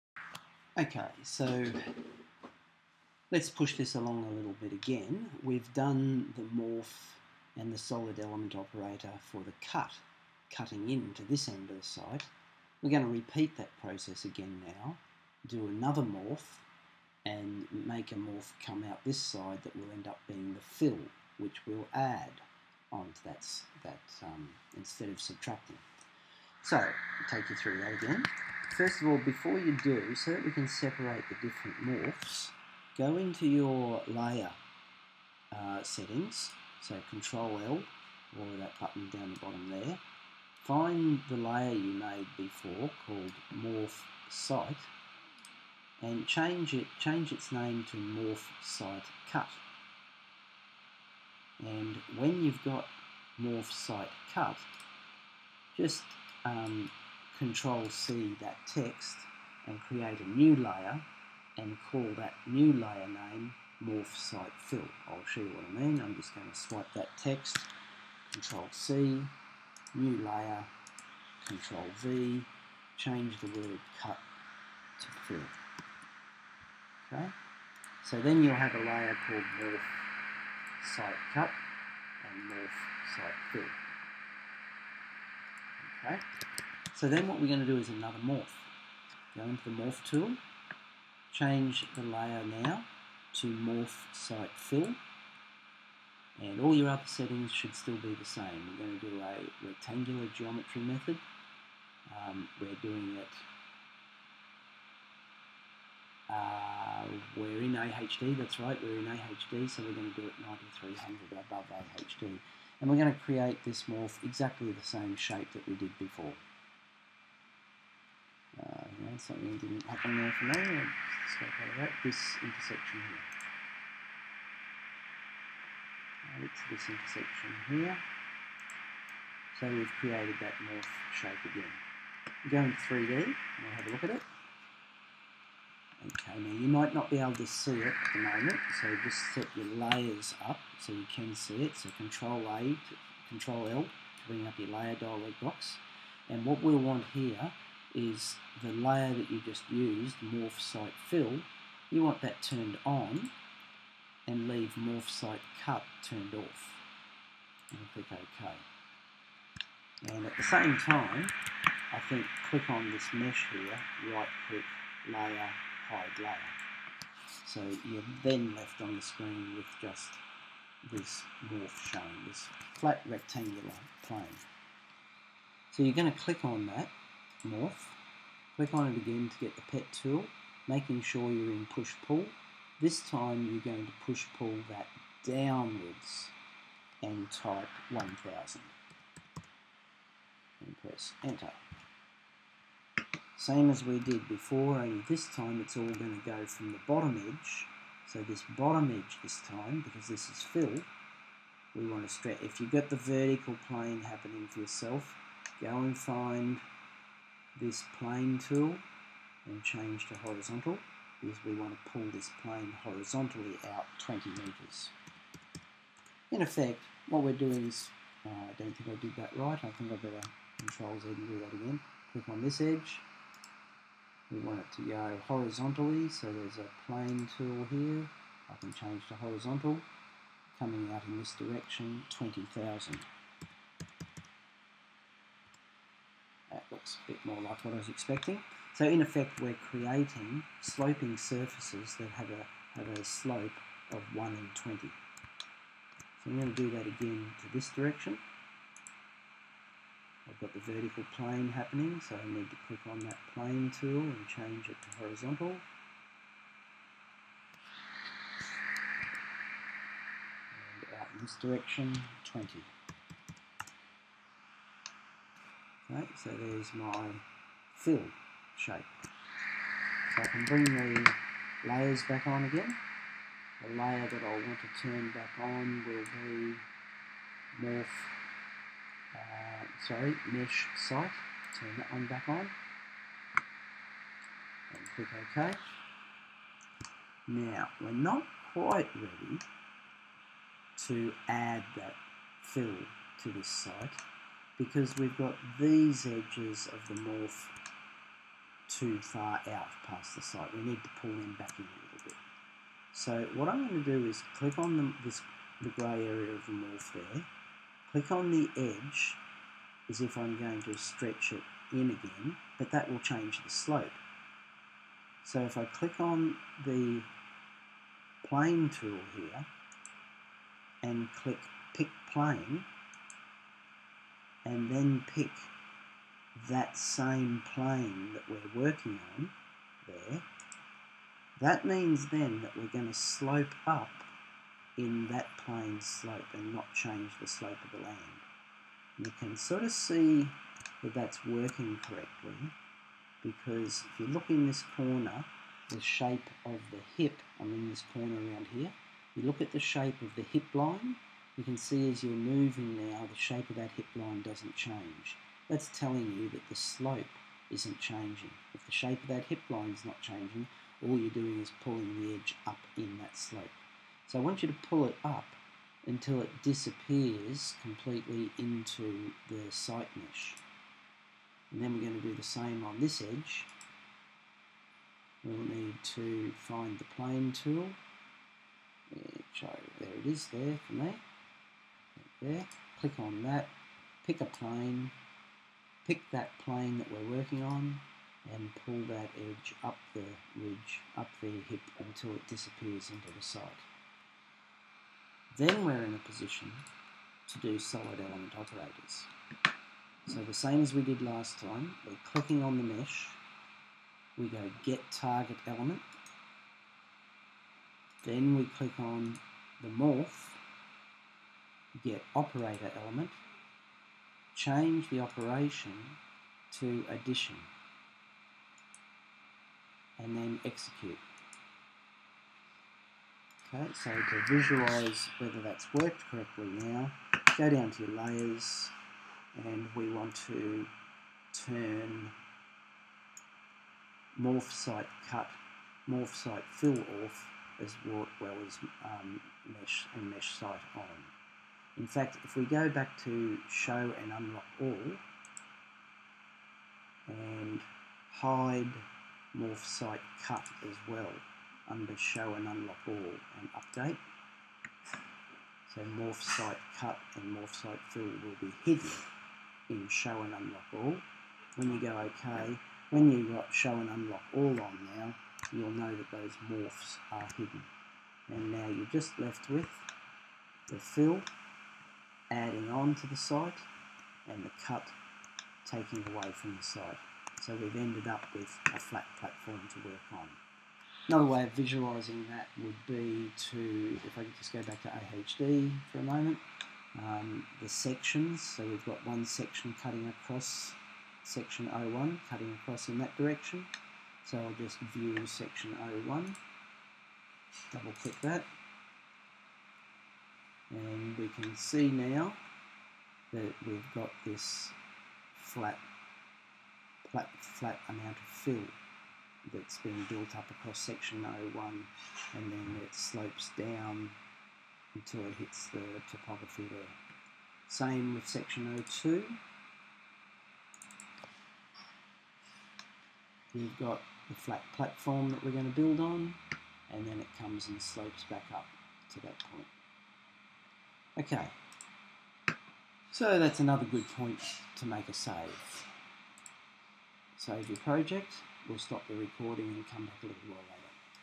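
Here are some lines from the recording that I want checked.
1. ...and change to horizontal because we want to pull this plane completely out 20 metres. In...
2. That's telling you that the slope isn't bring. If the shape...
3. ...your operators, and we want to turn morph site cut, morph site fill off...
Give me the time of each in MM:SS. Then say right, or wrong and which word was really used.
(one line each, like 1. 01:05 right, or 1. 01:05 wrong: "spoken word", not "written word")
1. 03:29 wrong: "horizontally", not "completely"
2. 05:55 wrong: "changing", not "bring"
3. 07:07 wrong: "layers", not "operators".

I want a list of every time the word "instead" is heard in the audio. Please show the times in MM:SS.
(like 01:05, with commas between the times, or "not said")
00:24.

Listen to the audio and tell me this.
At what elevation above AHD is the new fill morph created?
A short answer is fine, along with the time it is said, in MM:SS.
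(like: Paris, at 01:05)
9300, at 01:50.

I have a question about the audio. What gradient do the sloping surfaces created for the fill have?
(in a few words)
1 in 20.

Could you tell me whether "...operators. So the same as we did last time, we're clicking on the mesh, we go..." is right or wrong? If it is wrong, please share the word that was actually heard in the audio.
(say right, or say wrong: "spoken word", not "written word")
right.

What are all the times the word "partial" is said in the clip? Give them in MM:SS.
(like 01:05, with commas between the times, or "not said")
not said.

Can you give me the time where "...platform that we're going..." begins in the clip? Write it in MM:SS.
08:44.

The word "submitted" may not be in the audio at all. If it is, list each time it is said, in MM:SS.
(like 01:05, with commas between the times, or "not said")
not said.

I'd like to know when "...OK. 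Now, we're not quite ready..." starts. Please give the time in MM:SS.
04:45.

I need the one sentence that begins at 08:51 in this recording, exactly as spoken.
Okay, so that's another good point to make a save.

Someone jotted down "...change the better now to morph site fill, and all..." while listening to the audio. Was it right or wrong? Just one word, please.
wrong.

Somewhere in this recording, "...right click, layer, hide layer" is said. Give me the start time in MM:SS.
02:44.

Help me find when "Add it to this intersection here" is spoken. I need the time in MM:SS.
02:06.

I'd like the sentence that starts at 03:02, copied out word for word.
This time you're going to push-pull that downwards and type 1000 and press enter.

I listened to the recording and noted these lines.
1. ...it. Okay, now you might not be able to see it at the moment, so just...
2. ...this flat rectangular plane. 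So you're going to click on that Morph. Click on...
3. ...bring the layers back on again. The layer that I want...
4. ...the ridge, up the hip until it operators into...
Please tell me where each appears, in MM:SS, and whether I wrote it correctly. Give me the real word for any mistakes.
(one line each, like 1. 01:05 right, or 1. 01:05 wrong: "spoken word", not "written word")
1. 02:14 right
2. 02:52 right
3. 04:30 right
4. 06:29 wrong: "disappears", not "operators".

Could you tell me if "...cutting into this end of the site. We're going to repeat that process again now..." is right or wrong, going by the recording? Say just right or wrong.
right.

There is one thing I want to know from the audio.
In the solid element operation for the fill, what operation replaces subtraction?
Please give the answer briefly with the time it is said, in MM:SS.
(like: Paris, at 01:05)
Addition, at 06:56.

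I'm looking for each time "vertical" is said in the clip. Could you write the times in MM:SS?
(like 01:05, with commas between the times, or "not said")
03:22, 04:10.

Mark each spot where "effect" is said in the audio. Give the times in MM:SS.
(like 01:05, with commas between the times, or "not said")
03:36, 03:59.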